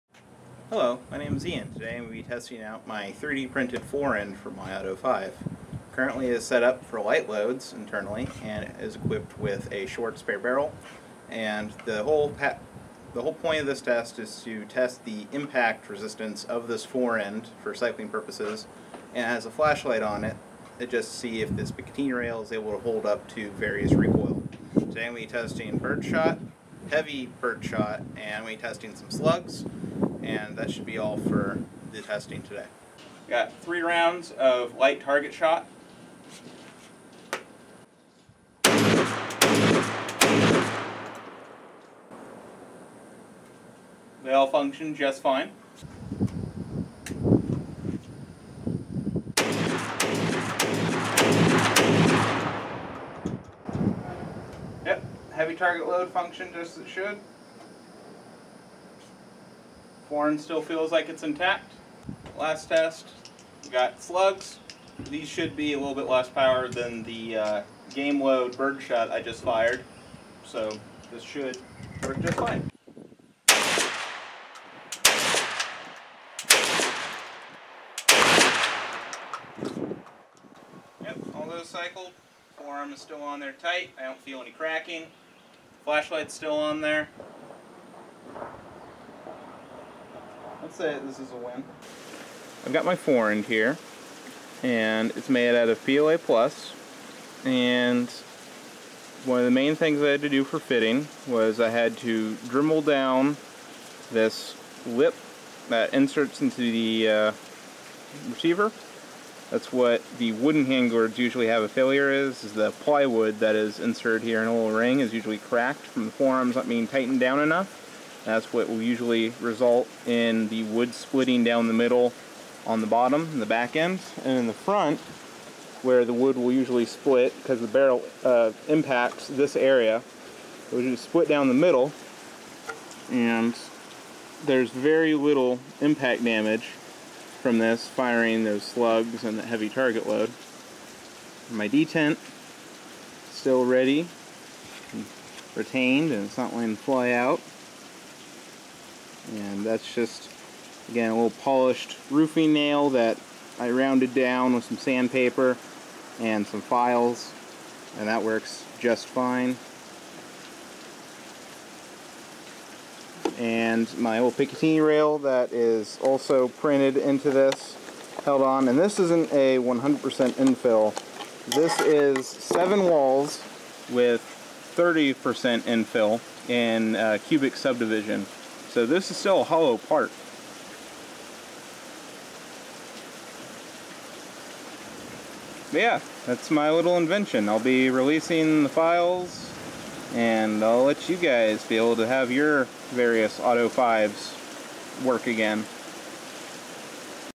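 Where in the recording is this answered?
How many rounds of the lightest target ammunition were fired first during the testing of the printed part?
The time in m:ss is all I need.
0:33.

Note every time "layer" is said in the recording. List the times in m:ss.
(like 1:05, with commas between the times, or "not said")
not said.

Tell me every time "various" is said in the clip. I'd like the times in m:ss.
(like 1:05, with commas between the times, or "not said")
0:23, 3:12.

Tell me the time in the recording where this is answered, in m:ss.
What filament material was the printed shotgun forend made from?
1:35.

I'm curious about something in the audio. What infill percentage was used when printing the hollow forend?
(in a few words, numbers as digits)
30%.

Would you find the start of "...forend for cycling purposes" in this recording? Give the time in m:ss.
0:16.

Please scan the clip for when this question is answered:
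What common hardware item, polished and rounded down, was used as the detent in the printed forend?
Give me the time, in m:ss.
2:32.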